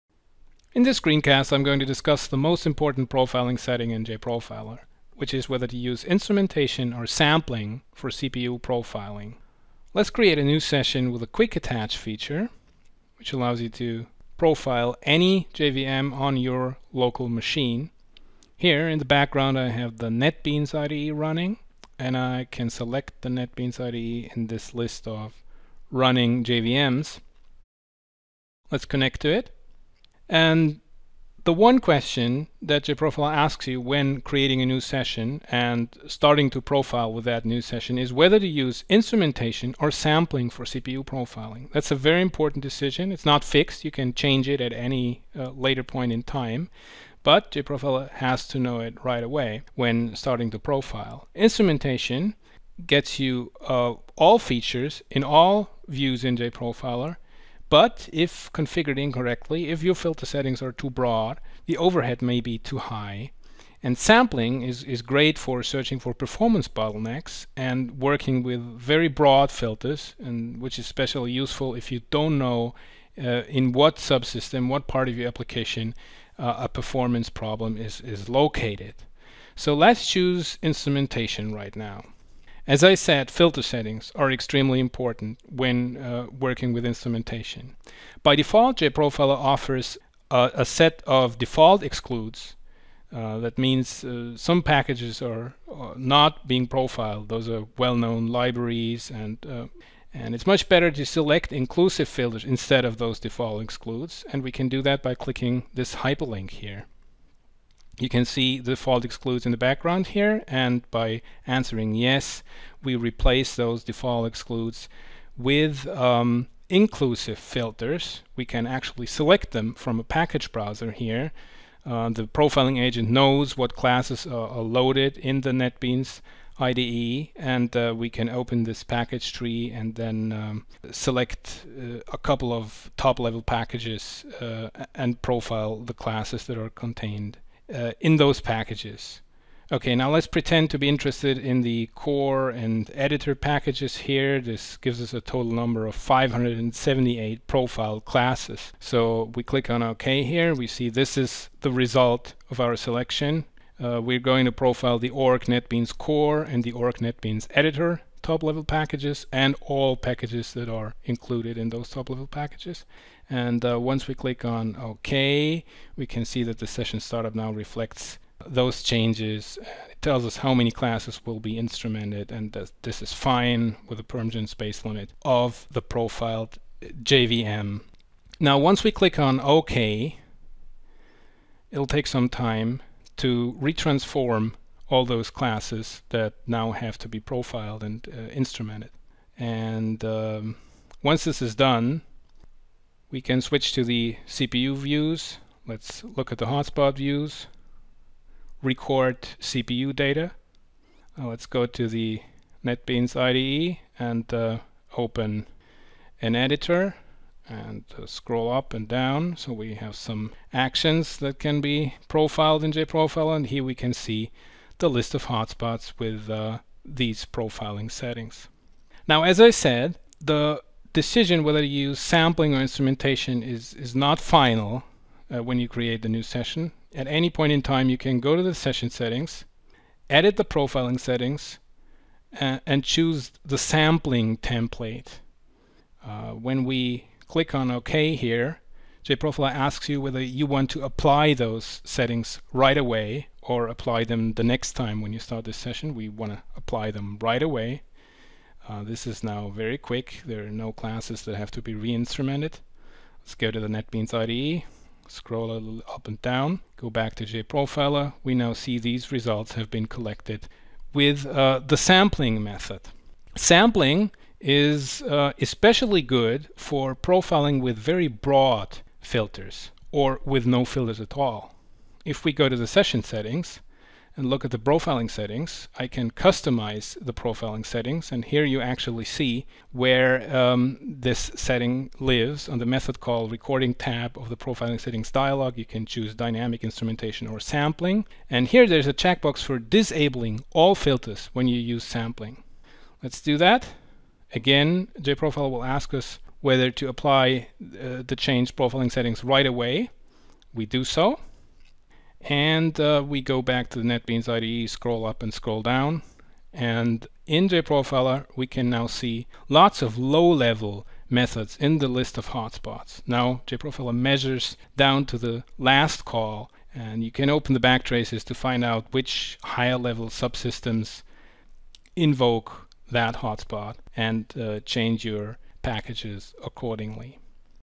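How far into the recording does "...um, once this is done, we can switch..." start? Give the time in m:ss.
3:10.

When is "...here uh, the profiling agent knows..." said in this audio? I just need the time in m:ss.
2:00.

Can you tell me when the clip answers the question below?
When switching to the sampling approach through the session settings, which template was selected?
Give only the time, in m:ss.
3:53.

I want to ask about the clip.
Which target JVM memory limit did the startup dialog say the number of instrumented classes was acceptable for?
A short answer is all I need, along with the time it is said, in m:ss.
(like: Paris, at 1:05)
PermGen space, at 2:54.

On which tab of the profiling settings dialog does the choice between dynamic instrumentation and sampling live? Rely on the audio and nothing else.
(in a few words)
method call recording.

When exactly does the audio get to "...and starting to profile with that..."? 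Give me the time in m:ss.
0:35.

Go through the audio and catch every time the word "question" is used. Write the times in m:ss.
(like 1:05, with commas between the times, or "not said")
0:31.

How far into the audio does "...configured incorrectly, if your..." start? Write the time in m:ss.
0:58.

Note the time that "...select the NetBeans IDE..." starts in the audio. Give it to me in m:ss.
0:22.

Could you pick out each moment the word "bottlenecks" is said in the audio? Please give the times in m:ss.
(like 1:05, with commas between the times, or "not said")
1:06.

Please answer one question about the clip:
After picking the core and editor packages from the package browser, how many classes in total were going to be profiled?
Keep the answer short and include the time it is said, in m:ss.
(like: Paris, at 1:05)
578, at 2:25.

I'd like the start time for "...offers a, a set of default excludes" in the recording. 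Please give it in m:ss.
1:29.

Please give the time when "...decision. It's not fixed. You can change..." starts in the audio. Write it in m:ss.
0:42.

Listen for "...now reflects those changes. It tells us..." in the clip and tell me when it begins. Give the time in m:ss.
2:47.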